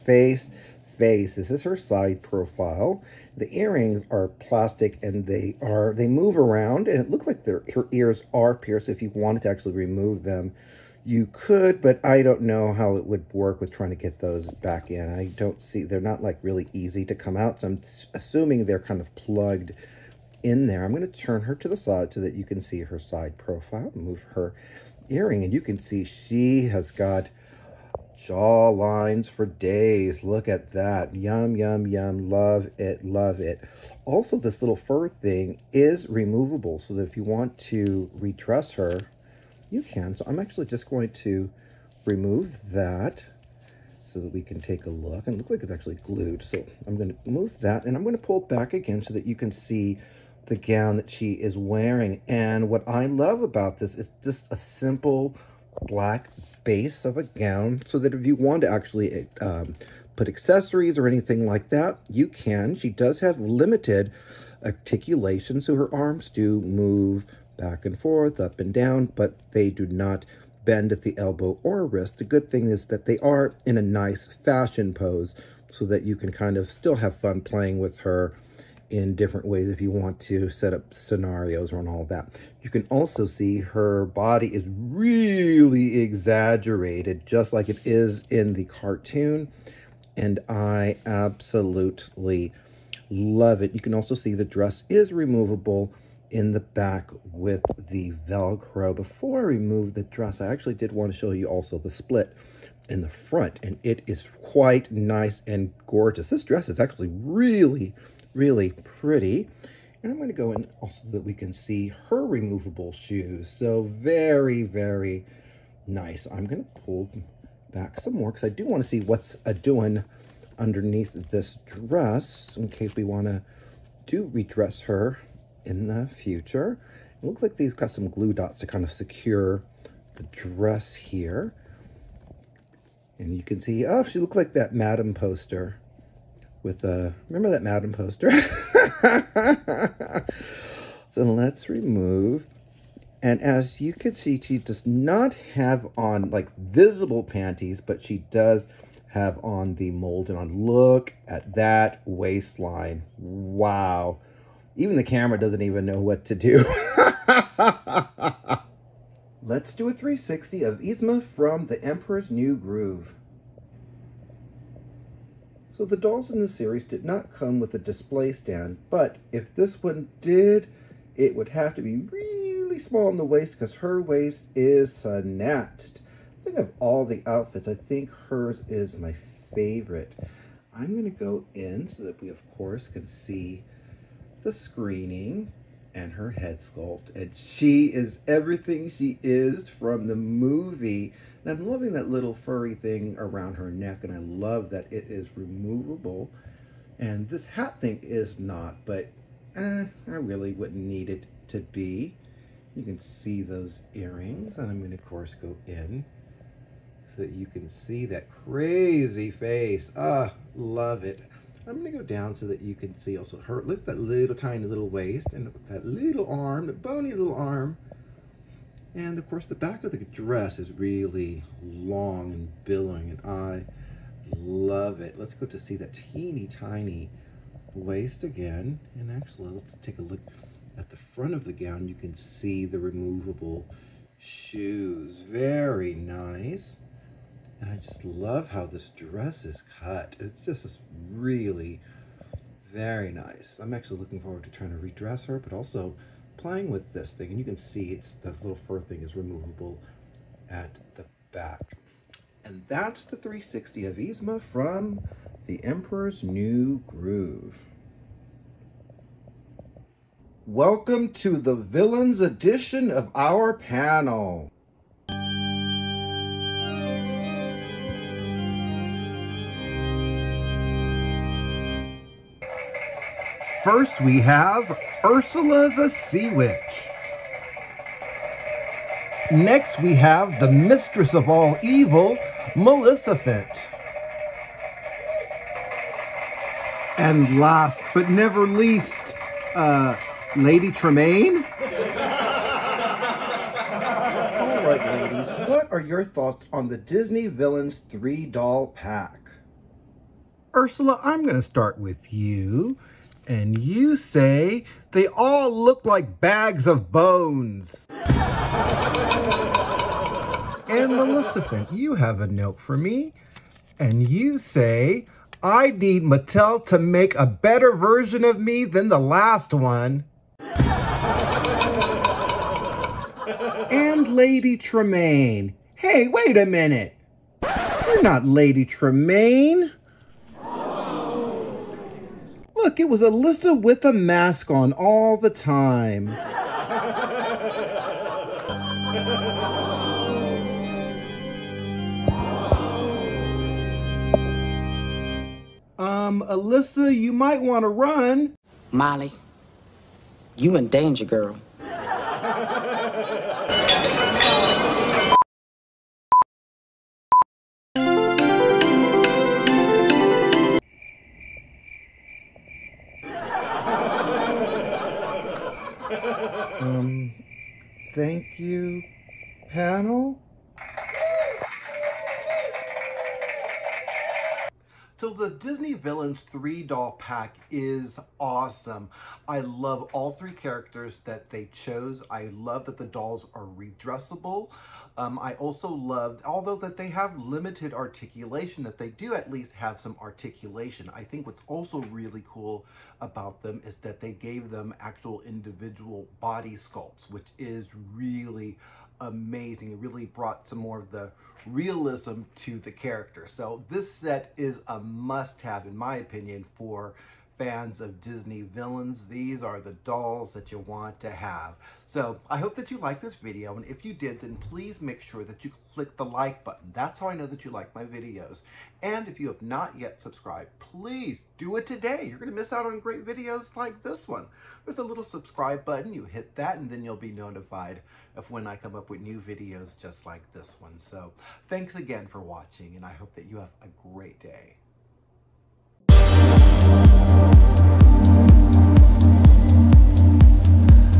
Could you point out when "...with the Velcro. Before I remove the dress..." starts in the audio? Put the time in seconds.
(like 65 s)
97 s.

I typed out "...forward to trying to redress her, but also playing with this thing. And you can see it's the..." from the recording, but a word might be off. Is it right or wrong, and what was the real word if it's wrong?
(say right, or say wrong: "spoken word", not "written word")
right.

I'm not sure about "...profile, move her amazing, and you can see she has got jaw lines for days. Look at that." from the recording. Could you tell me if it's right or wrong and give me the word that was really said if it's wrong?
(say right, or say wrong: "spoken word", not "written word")
wrong: "earring", not "amazing".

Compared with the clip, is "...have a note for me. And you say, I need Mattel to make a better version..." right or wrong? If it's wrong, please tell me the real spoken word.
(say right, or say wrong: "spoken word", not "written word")
right.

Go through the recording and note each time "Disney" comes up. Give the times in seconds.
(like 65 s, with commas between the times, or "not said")
296 s, 375 s, 408 s.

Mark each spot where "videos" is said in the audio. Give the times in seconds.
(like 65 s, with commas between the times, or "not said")
413 s, 417 s, 423 s, 429 s.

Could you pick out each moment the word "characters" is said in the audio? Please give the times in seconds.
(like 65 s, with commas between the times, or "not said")
380 s, 402 s.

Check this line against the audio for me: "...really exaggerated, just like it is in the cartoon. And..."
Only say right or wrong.
right.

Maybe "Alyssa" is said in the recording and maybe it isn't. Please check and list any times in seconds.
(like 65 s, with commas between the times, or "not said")
332 s, 346 s.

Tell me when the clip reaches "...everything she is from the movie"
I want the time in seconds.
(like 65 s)
188 s.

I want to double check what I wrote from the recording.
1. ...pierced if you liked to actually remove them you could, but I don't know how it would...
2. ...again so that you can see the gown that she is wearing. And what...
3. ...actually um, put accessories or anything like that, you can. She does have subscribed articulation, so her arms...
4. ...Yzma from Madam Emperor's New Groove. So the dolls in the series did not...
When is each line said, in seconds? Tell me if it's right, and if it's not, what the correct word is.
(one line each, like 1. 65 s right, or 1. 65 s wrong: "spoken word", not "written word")
1. 8 s wrong: "wanted", not "liked"
2. 48 s right
3. 58 s wrong: "limited", not "subscribed"
4. 160 s wrong: "The", not "Madam".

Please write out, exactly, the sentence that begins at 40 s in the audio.
So I'm actually just going to remove that so that we can take a look.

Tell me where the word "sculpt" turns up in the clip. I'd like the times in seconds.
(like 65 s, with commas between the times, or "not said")
186 s, 396 s.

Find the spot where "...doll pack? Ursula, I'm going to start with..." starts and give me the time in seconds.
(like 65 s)
298 s.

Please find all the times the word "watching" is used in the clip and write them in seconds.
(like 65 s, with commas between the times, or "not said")
432 s.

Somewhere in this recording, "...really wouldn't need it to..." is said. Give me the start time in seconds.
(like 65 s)
200 s.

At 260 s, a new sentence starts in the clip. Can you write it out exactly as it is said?
Welcome to the Villains edition of our panel.